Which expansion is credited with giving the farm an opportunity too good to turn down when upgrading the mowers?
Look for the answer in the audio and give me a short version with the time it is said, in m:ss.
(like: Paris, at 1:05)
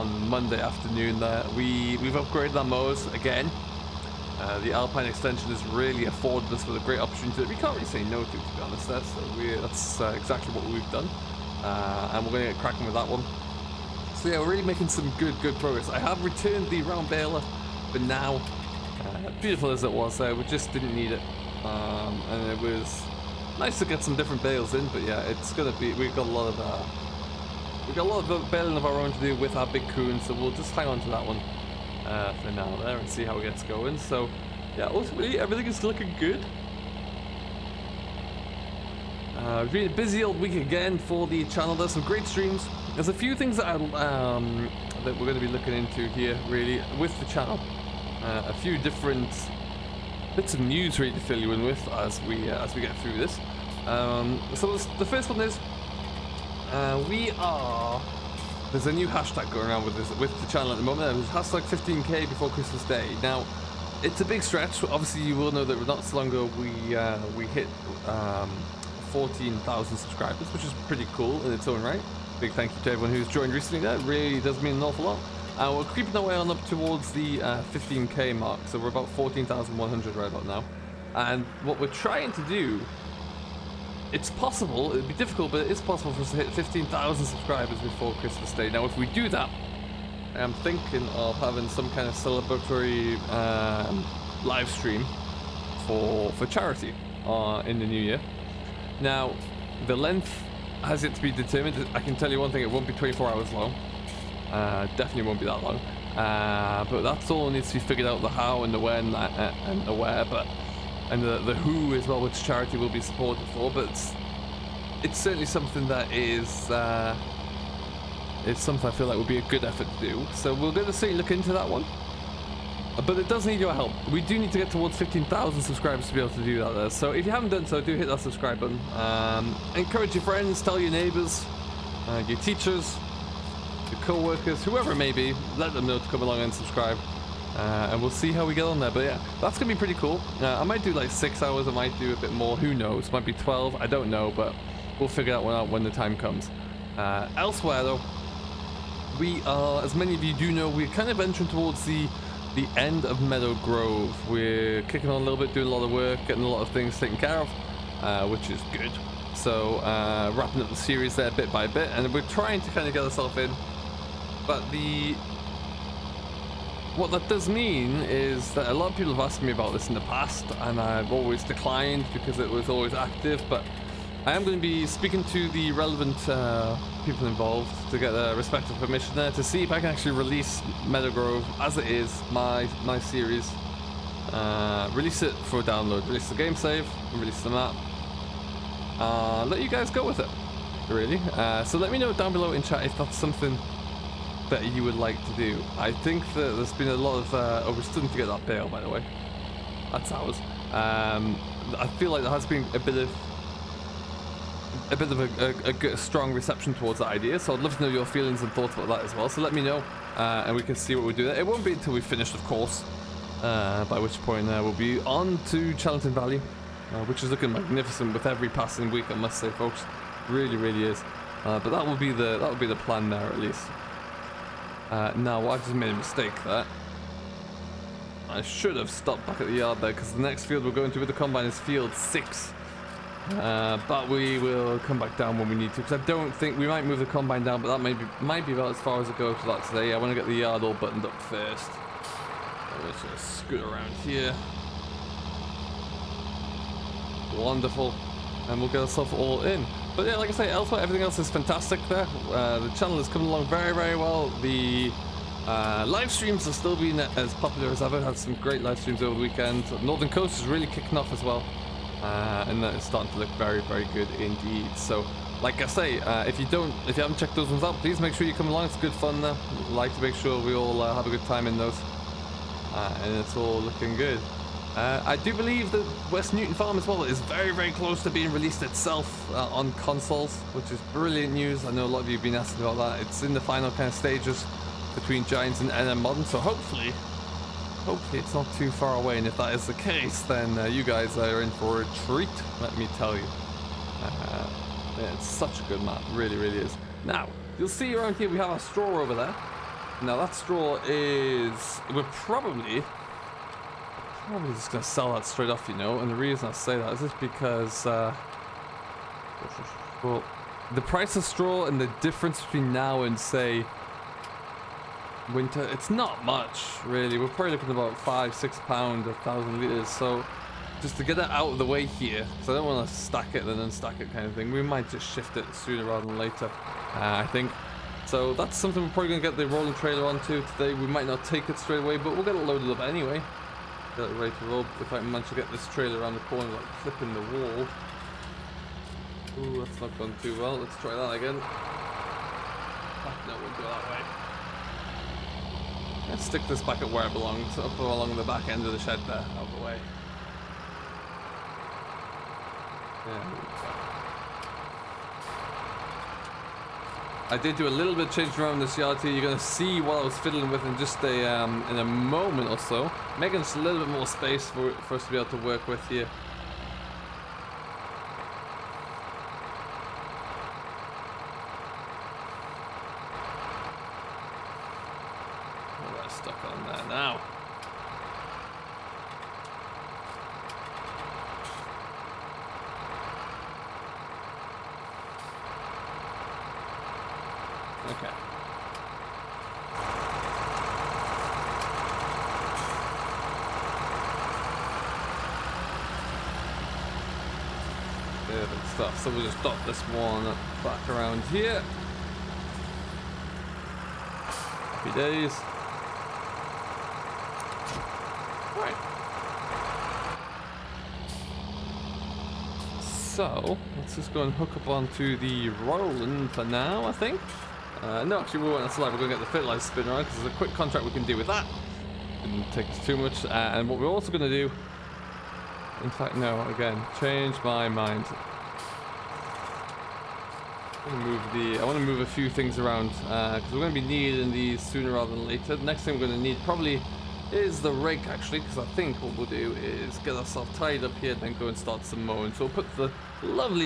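Alpine extension, at 0:04.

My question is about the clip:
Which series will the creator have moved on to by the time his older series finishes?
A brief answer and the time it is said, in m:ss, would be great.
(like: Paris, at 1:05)
Charlton Valley, at 3:35.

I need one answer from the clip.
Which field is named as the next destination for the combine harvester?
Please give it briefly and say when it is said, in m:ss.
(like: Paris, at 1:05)
field 6, at 3:51.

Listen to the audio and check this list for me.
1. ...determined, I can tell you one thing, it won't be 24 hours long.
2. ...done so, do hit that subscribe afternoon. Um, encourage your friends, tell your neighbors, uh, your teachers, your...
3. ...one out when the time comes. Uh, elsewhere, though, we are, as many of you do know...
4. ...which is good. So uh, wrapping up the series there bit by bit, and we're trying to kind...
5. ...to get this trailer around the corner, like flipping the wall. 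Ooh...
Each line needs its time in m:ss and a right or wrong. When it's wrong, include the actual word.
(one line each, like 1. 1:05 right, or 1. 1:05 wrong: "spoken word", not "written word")
1. 1:41 right
2. 2:07 wrong: "button", not "afternoon"
3. 2:25 right
4. 2:38 right
5. 5:35 right.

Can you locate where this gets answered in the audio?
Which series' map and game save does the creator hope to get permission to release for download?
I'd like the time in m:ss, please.
3:00.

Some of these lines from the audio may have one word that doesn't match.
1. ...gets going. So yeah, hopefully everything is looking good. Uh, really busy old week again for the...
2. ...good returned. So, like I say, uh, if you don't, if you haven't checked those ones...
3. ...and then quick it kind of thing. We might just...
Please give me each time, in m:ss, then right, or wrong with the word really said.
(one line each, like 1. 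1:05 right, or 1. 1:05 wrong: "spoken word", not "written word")
1. 0:33 wrong: "ultimately", not "hopefully"
2. 4:23 wrong: "indeed", not "returned"
3. 5:23 wrong: "stack", not "quick".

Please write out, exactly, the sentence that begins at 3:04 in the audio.
Uh, release it for download, release the game save, release the map.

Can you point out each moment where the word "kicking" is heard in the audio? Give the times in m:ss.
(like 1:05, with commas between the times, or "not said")
2:34, 4:20.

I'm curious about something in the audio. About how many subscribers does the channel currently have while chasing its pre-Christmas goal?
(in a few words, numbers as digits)
14,100.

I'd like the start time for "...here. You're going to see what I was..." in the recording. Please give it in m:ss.
5:59.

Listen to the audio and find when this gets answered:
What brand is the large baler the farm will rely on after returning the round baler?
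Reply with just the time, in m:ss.
0:29.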